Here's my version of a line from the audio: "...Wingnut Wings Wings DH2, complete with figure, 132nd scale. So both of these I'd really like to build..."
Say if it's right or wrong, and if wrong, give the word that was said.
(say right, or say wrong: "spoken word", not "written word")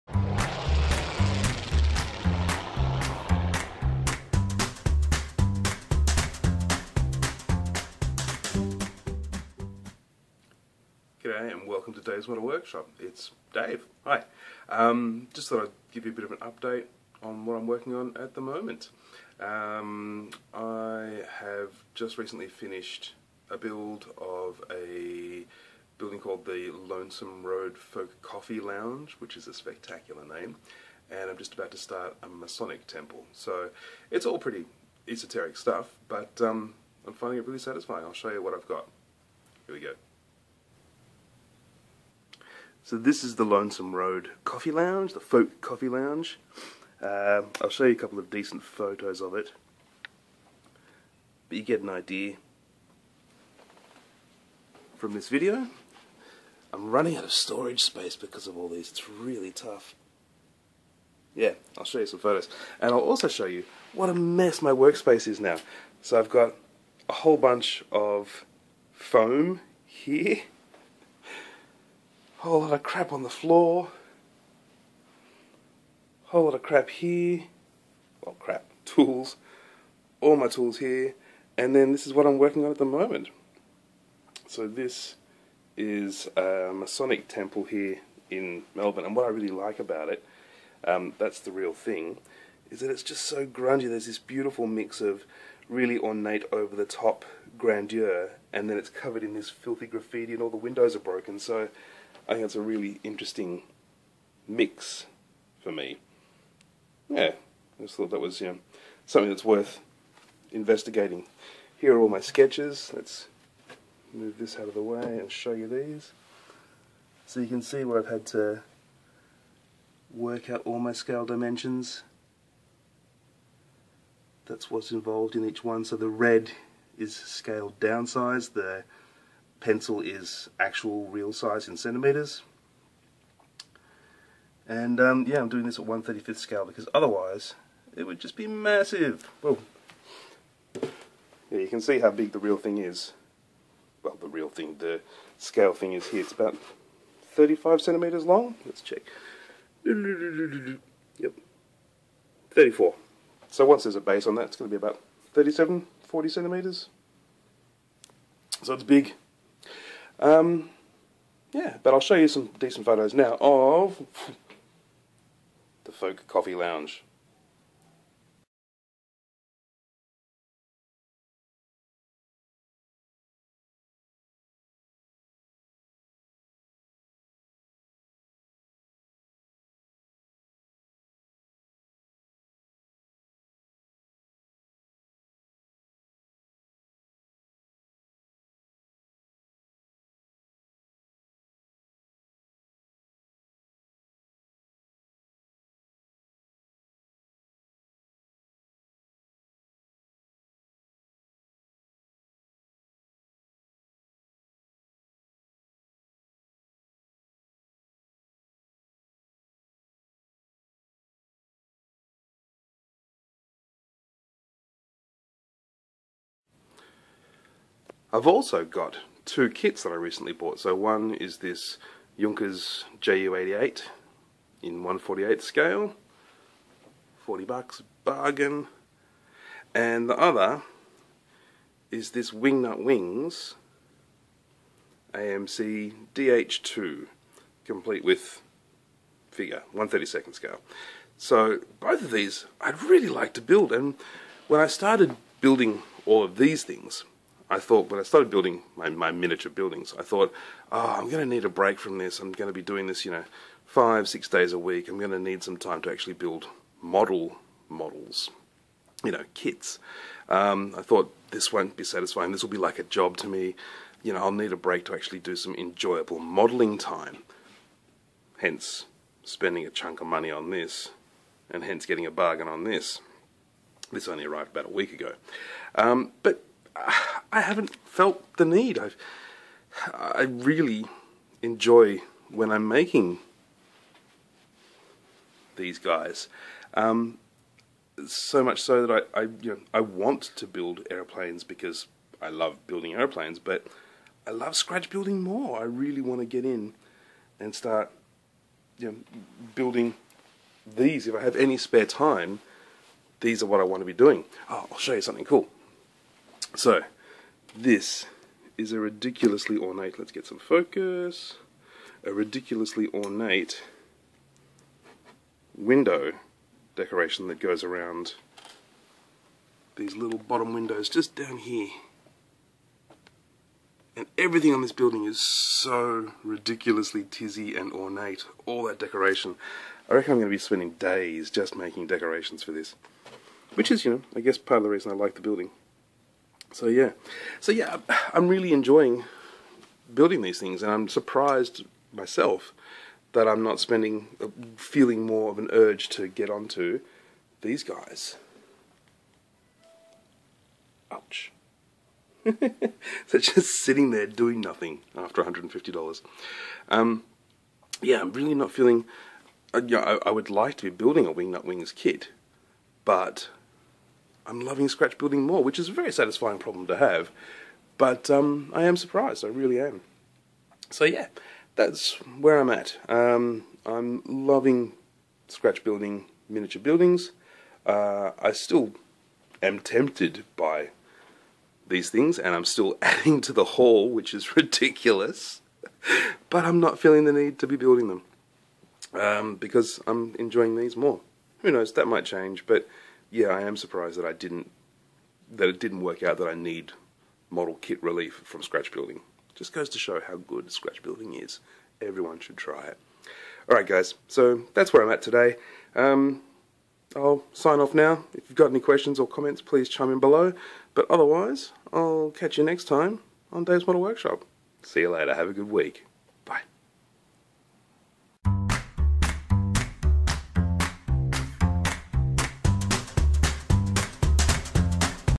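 wrong: "AMC", not "Wings".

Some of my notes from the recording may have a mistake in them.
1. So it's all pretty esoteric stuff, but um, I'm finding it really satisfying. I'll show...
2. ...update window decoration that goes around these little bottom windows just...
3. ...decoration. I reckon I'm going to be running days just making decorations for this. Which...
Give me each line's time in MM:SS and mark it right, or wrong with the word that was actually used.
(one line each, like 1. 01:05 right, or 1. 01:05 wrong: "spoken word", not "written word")
1. 00:33 right
2. 05:12 wrong: "ornate", not "update"
3. 05:28 wrong: "spending", not "running".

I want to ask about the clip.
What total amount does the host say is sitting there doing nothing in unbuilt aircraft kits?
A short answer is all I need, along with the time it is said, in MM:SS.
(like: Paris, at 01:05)
$150, at 05:55.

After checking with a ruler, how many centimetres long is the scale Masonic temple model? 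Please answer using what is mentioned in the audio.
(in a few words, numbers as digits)
34.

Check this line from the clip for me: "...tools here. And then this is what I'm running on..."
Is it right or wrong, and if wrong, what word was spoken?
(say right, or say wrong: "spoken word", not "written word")
wrong: "working", not "running".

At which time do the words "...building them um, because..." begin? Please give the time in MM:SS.
06:27.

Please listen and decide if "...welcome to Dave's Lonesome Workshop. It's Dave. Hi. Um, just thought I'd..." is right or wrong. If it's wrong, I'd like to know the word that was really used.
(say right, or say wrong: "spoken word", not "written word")
wrong: "Model", not "Lonesome".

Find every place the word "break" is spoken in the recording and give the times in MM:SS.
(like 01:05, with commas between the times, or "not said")
04:11, 04:24.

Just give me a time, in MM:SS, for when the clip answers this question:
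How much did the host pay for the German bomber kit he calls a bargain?
03:47.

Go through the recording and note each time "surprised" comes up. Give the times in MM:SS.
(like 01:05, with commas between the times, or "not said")
05:40, 06:08, 06:33.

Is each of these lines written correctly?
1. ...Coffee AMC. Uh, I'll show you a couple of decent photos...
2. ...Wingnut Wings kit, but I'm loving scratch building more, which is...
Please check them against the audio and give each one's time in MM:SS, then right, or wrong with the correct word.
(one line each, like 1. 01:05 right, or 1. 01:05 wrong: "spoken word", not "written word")
1. 00:45 wrong: "Lounge", not "AMC"
2. 06:01 right.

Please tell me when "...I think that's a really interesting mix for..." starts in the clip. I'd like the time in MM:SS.
01:42.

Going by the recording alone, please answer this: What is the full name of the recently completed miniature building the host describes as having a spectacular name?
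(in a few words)
Lonesome Road Folk Coffee Lounge.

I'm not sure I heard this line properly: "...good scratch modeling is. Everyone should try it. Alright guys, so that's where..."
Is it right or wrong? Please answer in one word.
wrong.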